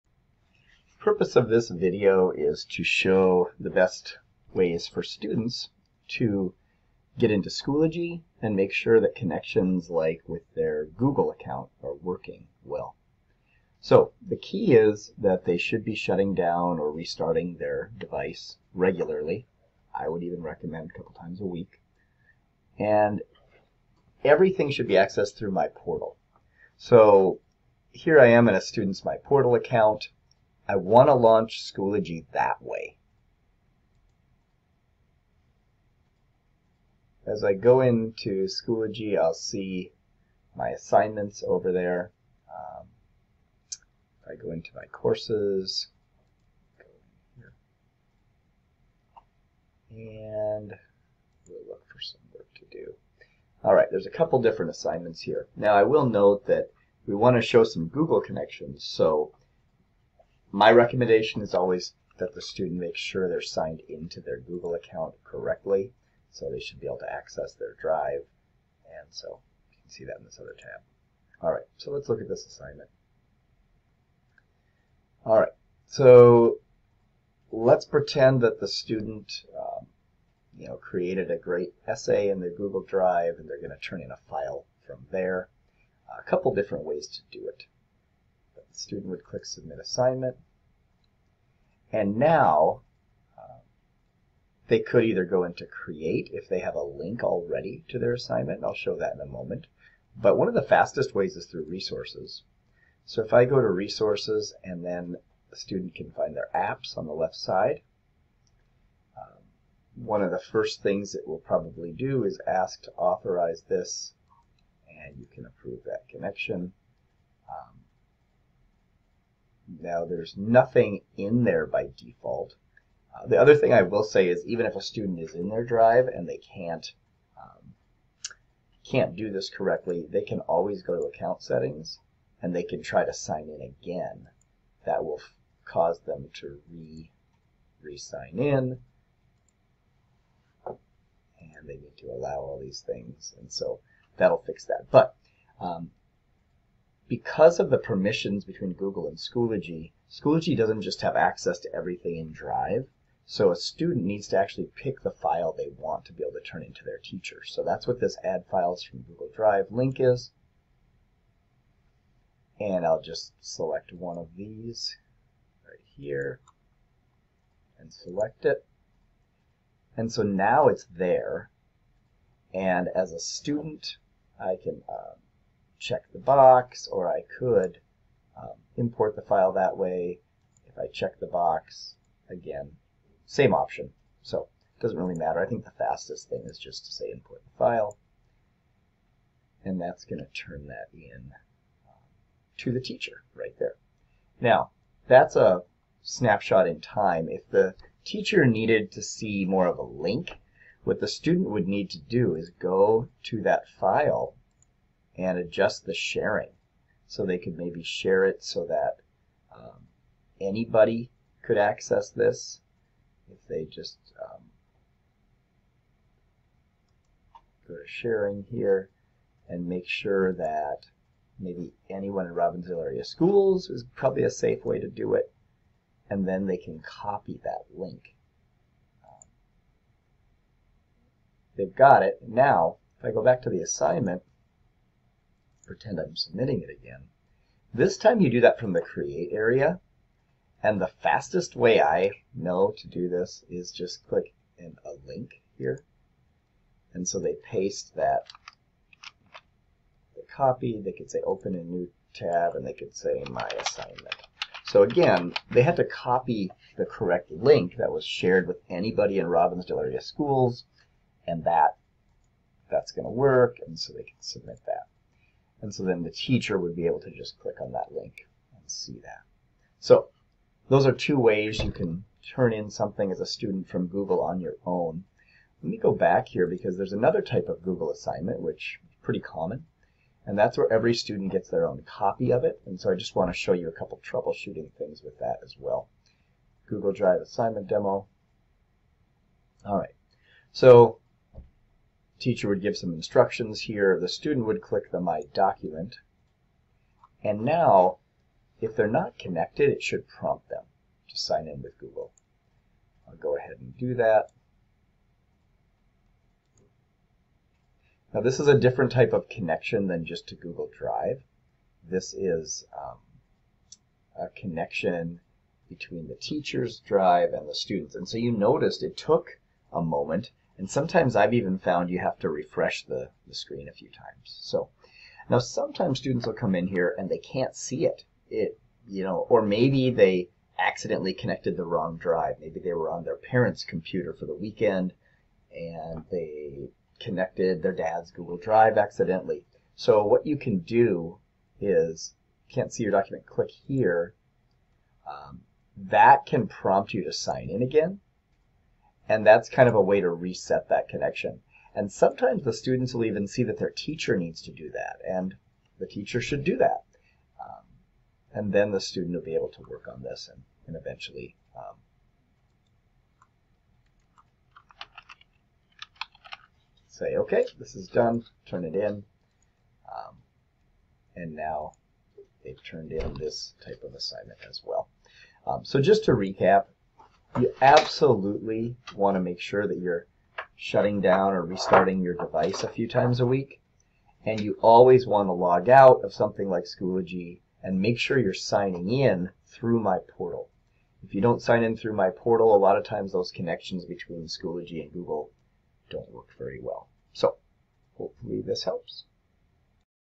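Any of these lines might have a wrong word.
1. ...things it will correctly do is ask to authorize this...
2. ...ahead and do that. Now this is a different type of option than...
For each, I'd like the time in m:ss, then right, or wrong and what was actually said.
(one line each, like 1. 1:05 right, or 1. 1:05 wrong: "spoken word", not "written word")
1. 1:50 wrong: "probably", not "correctly"
2. 5:03 wrong: "connection", not "option".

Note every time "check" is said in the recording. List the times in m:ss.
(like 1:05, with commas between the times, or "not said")
2:55, 3:00.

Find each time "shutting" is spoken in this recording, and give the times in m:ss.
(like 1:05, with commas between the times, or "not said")
0:15, 6:20.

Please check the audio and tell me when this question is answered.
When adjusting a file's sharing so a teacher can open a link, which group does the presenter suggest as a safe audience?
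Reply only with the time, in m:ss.
3:41.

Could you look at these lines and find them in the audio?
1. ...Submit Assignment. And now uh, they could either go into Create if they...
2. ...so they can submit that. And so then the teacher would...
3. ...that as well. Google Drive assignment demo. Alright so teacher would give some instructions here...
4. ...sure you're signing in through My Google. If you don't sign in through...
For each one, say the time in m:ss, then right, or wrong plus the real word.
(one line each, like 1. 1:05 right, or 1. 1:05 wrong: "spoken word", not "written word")
1. 1:29 right
2. 4:23 right
3. 4:45 right
4. 6:27 wrong: "Portal", not "Google".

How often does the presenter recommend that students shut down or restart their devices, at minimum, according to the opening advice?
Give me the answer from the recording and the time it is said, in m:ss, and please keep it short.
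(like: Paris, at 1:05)
A couple times a week, at 0:20.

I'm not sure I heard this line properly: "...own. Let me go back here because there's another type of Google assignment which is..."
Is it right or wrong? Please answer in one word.
right.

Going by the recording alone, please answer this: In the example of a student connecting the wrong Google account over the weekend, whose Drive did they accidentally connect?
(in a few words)
Their dad's.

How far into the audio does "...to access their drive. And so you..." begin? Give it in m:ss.
1:06.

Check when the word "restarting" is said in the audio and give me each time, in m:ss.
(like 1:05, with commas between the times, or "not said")
0:16, 6:21.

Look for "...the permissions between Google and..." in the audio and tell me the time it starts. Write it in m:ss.
2:27.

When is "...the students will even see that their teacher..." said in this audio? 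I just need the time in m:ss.
5:52.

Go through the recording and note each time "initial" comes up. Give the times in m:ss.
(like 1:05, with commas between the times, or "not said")
not said.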